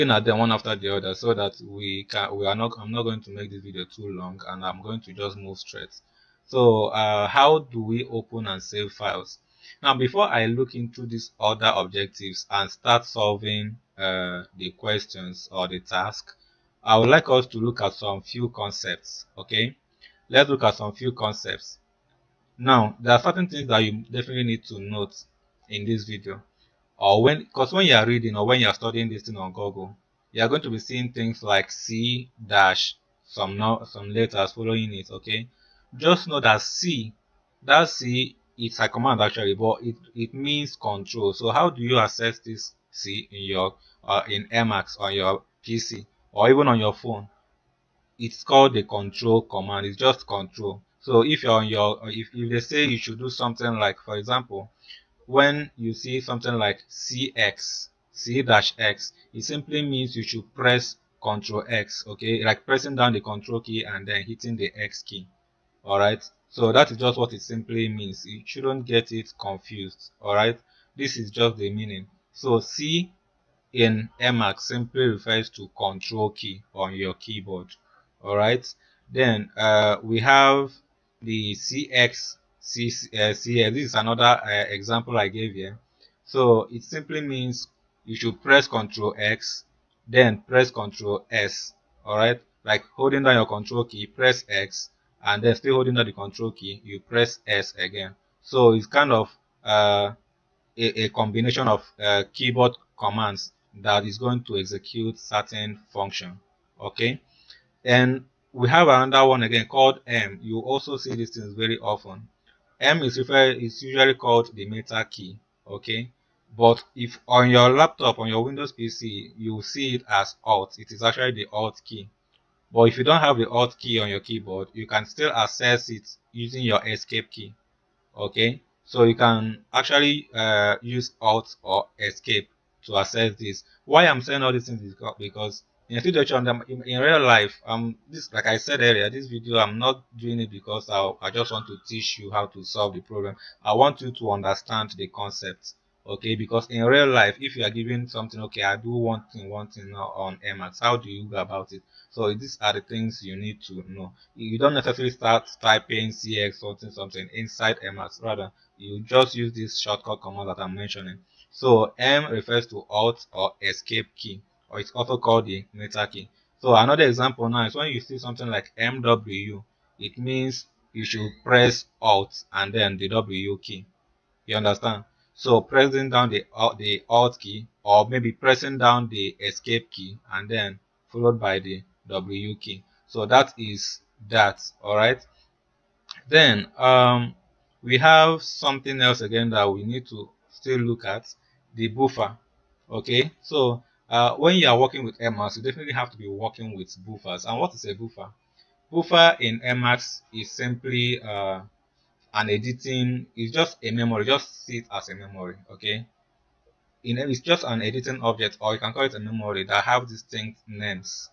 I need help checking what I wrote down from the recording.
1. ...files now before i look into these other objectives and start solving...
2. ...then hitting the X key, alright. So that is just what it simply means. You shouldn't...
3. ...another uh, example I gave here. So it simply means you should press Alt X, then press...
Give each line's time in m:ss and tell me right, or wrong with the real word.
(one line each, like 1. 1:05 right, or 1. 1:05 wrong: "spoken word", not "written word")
1. 0:08 right
2. 1:04 right
3. 1:23 wrong: "Ctrl", not "Alt".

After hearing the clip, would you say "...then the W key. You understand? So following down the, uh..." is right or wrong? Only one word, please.
wrong.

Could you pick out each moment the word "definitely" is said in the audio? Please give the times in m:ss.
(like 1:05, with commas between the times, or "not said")
0:24, 3:15.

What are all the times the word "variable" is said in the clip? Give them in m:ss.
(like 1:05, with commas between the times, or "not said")
not said.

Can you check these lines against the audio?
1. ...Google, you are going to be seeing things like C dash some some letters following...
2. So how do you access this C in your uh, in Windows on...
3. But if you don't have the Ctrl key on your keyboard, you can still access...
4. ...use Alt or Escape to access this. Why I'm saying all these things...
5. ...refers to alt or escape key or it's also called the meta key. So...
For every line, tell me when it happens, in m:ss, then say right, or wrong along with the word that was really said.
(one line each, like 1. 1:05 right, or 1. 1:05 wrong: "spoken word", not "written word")
1. 0:29 right
2. 0:41 wrong: "Emacs", not "Windows"
3. 2:02 wrong: "Alt", not "Ctrl"
4. 2:10 right
5. 2:42 right.